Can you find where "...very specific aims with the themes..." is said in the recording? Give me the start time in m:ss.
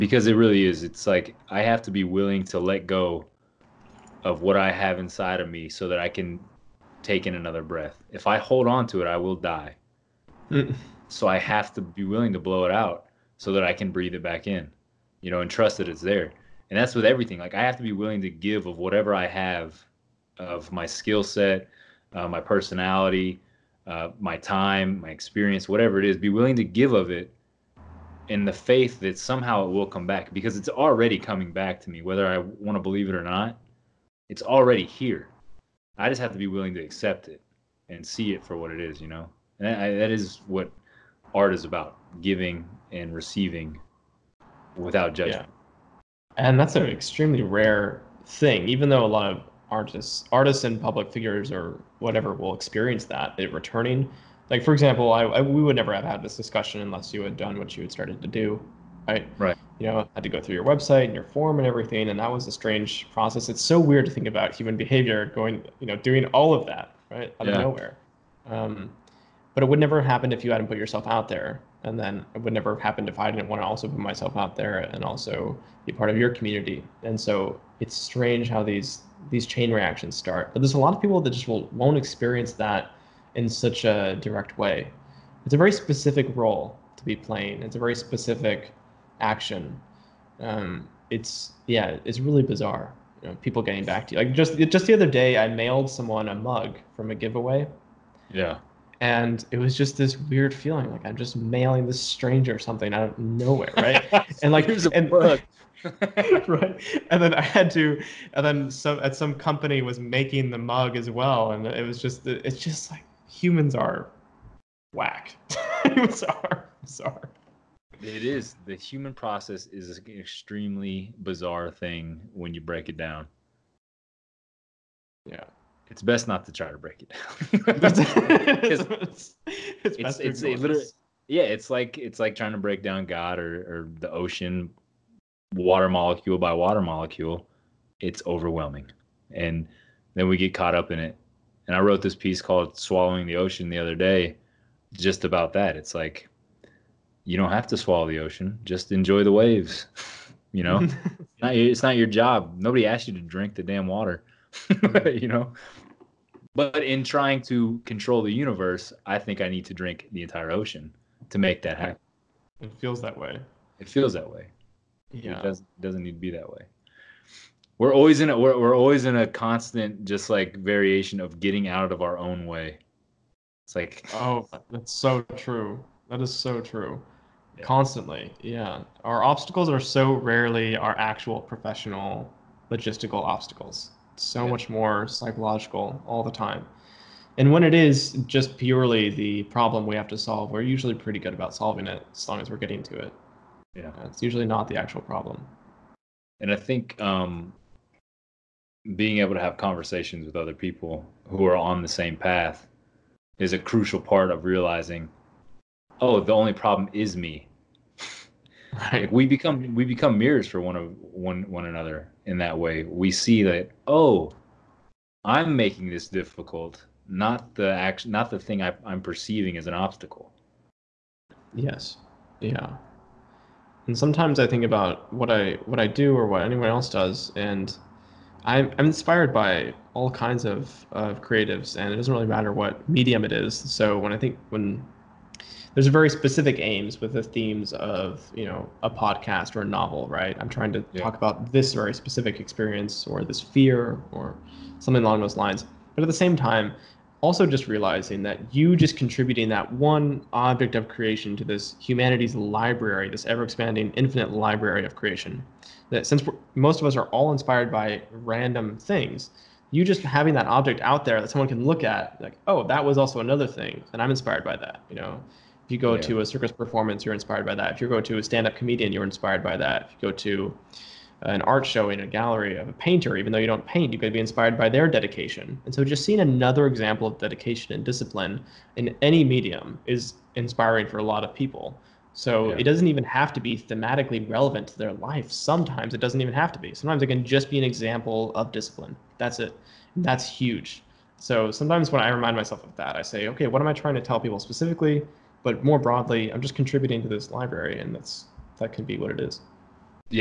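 3:55.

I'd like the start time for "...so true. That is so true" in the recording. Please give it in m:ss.
2:54.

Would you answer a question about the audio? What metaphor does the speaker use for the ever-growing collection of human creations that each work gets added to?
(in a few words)
infinite library.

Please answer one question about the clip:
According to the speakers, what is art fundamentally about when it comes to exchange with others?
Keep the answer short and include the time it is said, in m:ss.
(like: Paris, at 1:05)
giving and receiving without judgment, at 0:42.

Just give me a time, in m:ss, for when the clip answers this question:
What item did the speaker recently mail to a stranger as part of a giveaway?
1:36.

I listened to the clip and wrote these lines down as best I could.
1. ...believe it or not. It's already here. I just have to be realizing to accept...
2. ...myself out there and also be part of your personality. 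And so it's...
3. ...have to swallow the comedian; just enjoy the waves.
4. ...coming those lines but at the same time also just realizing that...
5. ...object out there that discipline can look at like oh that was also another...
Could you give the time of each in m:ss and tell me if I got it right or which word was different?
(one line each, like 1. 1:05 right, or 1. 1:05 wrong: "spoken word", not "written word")
1. 0:32 wrong: "willing", not "realizing"
2. 1:13 wrong: "community", not "personality"
3. 2:27 wrong: "ocean", not "comedian"
4. 4:05 wrong: "along", not "coming"
5. 4:20 wrong: "someone", not "discipline".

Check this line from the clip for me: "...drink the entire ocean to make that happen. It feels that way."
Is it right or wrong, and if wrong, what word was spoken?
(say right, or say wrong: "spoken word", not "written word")
right.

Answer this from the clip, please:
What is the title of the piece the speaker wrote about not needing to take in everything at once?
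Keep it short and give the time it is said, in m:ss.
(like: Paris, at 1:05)
Swallowing the Ocean, at 2:22.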